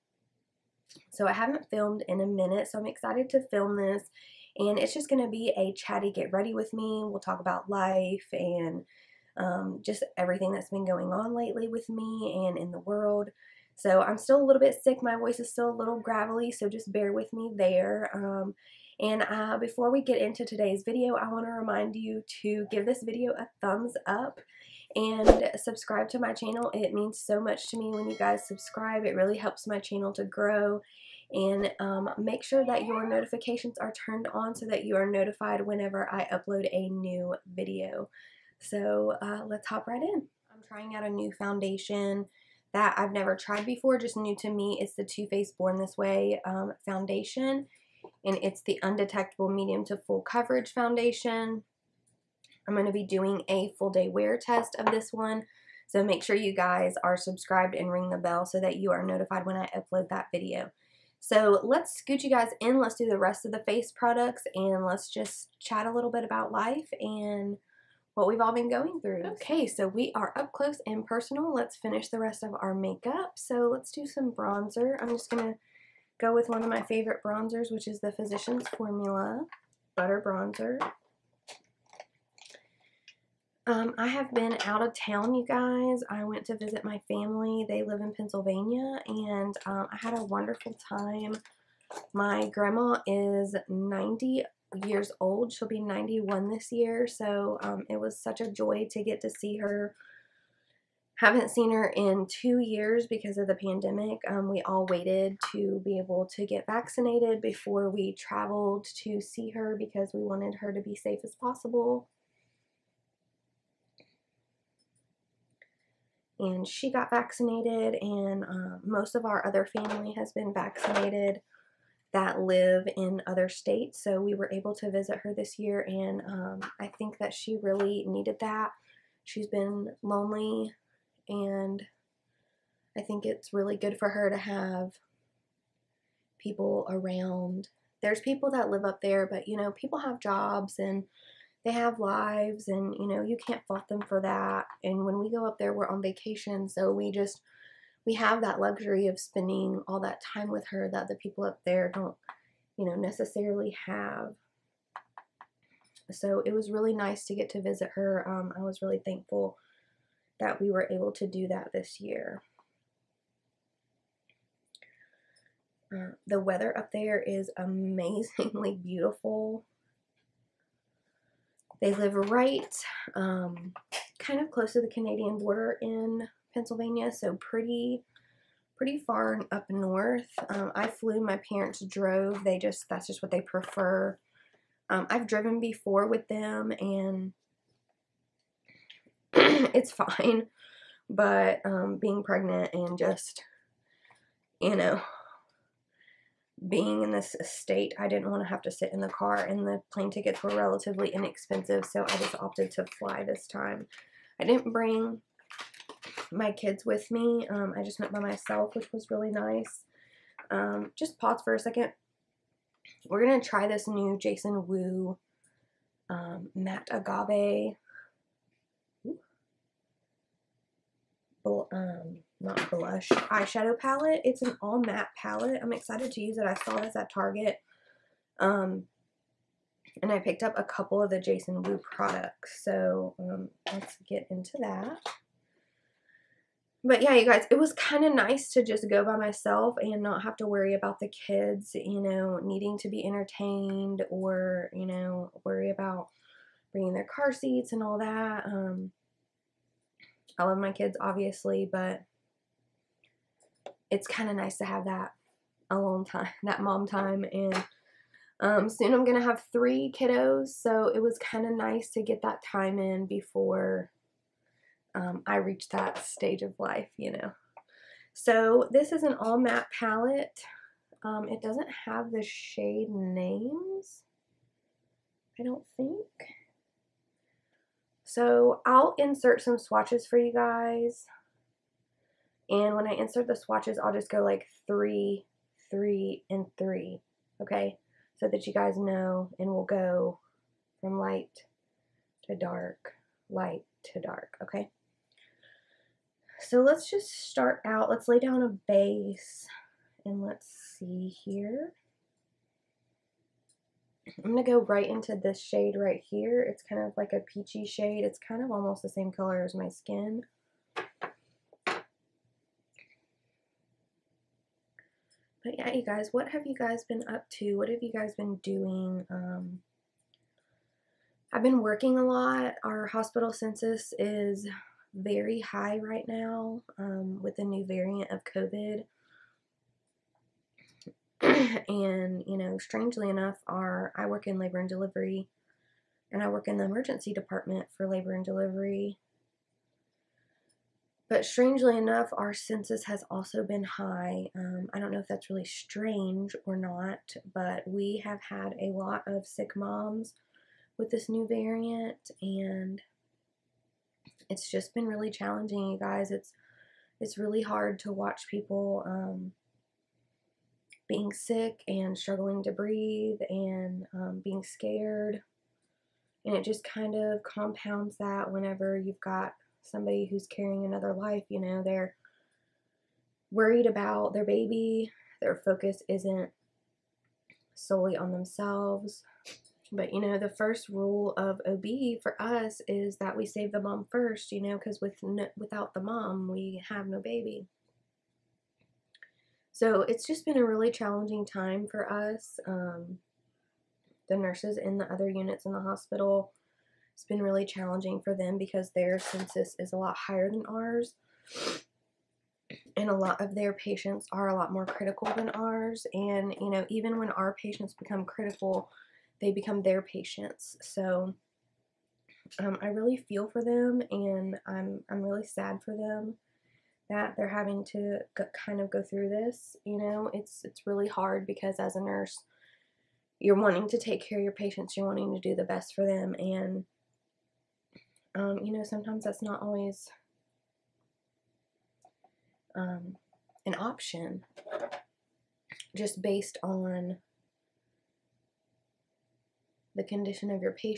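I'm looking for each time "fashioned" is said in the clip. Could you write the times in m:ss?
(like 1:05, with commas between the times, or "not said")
not said.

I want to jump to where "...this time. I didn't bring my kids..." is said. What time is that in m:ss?
3:23.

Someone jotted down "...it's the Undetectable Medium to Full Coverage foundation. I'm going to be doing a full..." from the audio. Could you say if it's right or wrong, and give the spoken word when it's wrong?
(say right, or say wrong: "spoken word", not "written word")
right.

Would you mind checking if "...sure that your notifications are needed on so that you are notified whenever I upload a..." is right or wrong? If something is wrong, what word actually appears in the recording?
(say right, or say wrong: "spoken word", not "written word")
wrong: "turned", not "needed".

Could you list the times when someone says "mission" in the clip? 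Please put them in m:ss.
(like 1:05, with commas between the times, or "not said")
not said.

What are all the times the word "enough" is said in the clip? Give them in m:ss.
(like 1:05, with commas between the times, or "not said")
5:33, 5:41.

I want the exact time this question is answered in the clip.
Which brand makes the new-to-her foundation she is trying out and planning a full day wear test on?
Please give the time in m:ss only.
0:45.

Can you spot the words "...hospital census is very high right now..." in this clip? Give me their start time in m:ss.
5:22.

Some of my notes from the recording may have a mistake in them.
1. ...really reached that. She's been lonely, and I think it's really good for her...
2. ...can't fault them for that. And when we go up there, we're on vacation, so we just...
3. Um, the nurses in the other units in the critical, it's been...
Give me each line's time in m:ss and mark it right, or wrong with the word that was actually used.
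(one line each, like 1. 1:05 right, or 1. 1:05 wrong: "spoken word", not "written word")
1. 2:07 wrong: "needed", not "reached"
2. 2:23 right
3. 6:32 wrong: "hospital", not "critical".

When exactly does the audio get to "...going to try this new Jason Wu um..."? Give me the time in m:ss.
3:33.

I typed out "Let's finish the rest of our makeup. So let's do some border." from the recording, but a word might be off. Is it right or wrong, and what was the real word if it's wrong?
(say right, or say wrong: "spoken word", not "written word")
wrong: "bronzer", not "border".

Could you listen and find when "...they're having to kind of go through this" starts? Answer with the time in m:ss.
6:57.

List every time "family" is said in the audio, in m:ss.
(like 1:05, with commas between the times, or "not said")
1:27, 1:59.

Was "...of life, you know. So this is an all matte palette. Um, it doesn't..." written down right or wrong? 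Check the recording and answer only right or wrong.
right.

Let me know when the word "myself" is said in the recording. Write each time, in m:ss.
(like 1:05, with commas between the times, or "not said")
3:28, 3:59.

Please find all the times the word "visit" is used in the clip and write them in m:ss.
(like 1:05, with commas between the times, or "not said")
1:26, 2:04, 2:37.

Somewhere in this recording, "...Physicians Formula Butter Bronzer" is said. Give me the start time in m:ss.
1:18.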